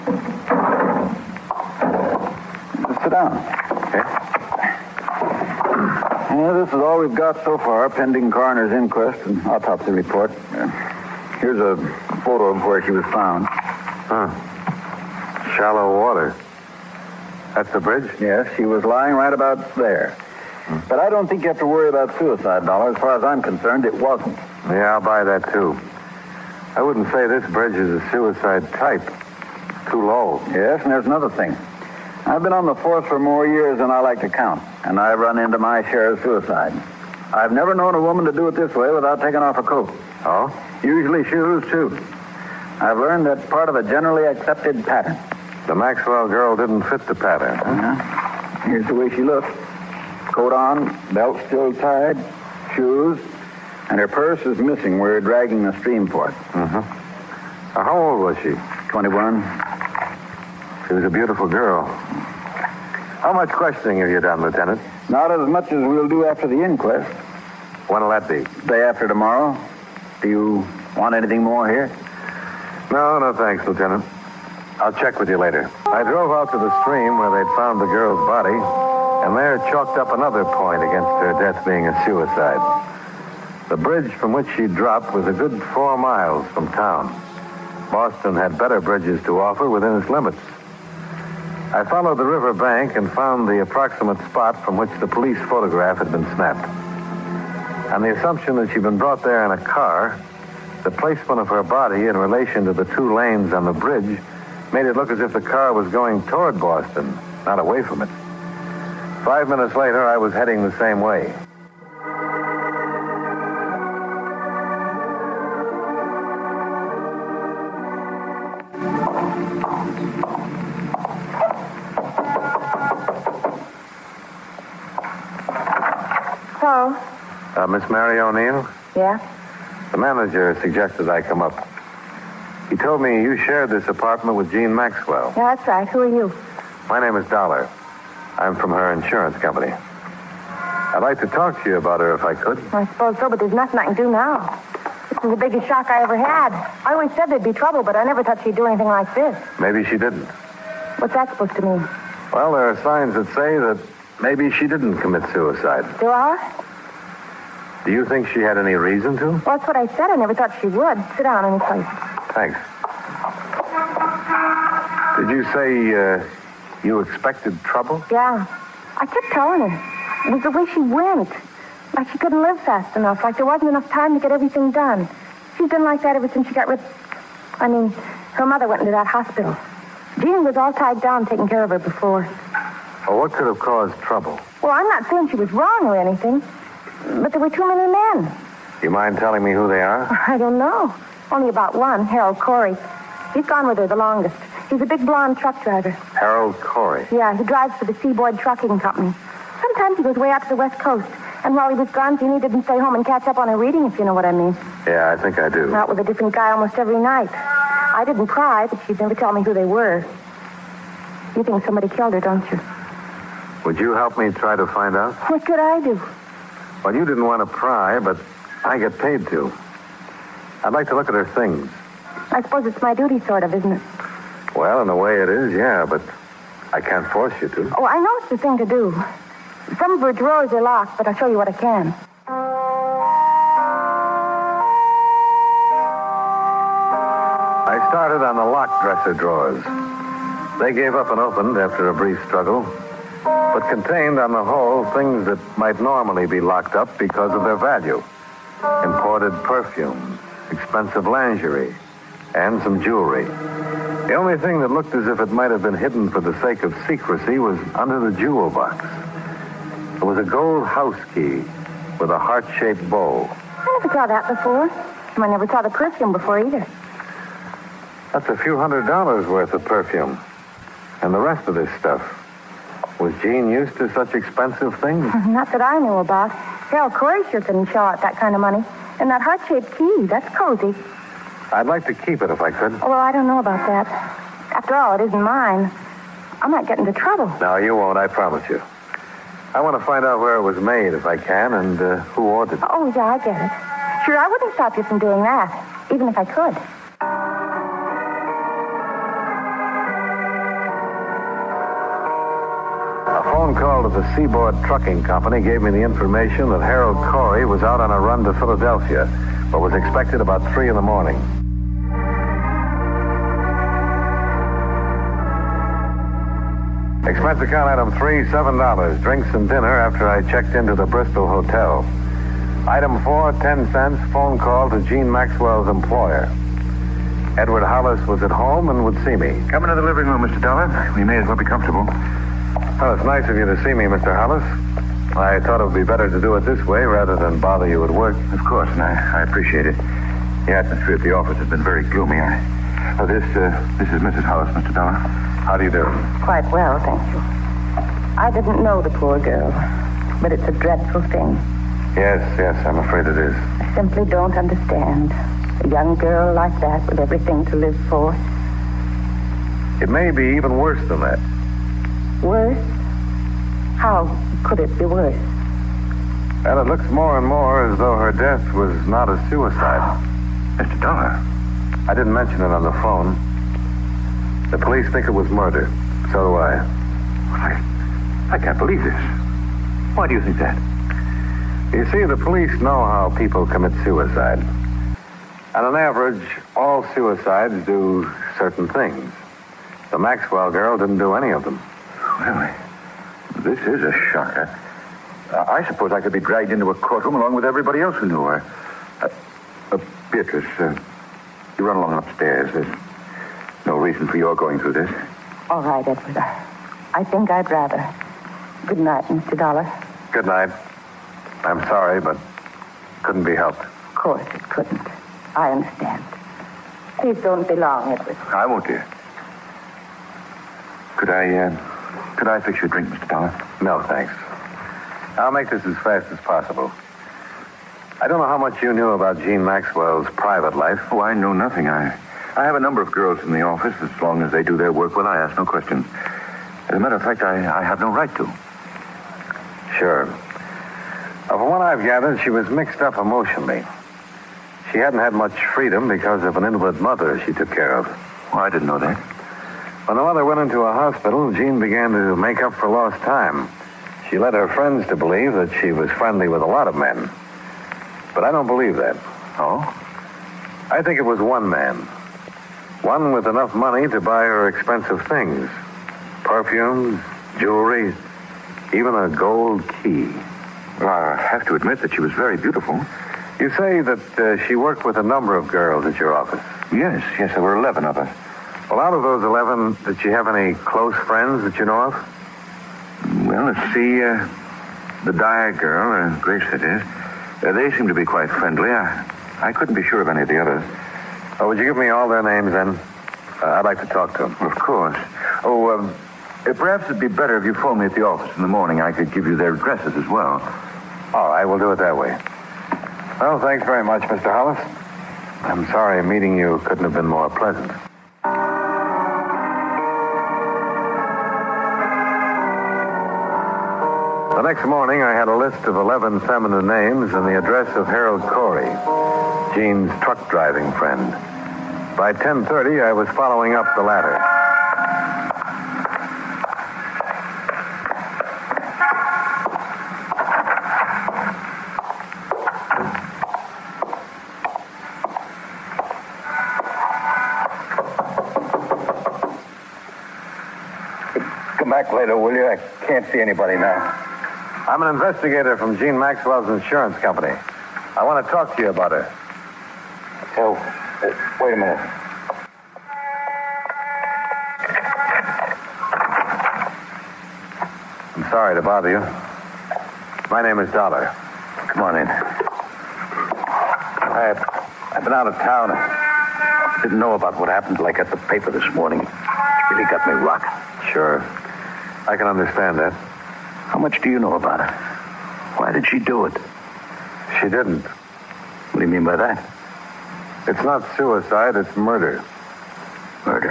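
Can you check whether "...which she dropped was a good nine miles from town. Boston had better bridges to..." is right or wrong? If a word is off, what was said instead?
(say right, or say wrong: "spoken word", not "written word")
wrong: "four", not "nine".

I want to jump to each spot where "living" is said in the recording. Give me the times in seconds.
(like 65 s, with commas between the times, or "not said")
329 s.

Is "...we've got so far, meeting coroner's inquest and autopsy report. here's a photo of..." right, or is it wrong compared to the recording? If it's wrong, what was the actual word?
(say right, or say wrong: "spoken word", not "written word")
wrong: "pending", not "meeting".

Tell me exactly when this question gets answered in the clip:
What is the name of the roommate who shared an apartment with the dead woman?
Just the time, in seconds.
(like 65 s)
127 s.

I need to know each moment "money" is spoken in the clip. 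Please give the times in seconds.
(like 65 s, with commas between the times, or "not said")
278 s, 463 s.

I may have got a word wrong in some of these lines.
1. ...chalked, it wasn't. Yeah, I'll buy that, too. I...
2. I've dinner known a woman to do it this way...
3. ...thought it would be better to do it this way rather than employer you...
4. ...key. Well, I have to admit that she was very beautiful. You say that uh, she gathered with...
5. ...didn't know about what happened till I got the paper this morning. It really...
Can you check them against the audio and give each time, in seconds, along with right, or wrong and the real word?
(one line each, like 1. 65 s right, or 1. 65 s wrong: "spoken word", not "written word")
1. 23 s wrong: "concerned", not "chalked"
2. 37 s wrong: "never", not "dinner"
3. 335 s wrong: "bother", not "employer"
4. 469 s wrong: "worked", not "gathered"
5. 566 s right.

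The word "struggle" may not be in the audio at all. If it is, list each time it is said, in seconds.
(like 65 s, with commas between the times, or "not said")
242 s.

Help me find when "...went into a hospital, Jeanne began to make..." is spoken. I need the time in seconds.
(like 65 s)
450 s.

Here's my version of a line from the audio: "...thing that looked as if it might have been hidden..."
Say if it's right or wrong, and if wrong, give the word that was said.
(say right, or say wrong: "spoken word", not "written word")
right.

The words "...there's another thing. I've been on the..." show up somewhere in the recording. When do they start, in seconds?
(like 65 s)
30 s.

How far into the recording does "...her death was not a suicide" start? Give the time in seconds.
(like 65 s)
367 s.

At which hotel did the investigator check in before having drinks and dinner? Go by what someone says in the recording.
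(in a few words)
Bristol Hotel.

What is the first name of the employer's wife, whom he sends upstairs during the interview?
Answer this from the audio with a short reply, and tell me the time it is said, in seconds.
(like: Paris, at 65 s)
Beatrice, at 400 s.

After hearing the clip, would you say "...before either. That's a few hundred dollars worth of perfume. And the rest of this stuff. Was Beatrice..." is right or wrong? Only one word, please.
wrong.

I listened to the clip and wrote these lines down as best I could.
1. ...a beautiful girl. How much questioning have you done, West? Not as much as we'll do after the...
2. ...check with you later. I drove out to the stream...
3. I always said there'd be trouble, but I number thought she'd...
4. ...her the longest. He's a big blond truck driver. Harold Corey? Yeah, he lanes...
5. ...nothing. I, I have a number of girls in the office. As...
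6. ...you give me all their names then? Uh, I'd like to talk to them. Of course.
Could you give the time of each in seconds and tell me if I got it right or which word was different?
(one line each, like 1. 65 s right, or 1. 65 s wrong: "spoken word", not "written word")
1. 61 s wrong: "Lieutenant", not "West"
2. 74 s right
3. 146 s wrong: "never", not "number"
4. 193 s wrong: "drives", not "lanes"
5. 431 s right
6. 491 s right.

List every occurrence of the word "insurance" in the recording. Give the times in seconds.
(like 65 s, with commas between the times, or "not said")
138 s, 546 s.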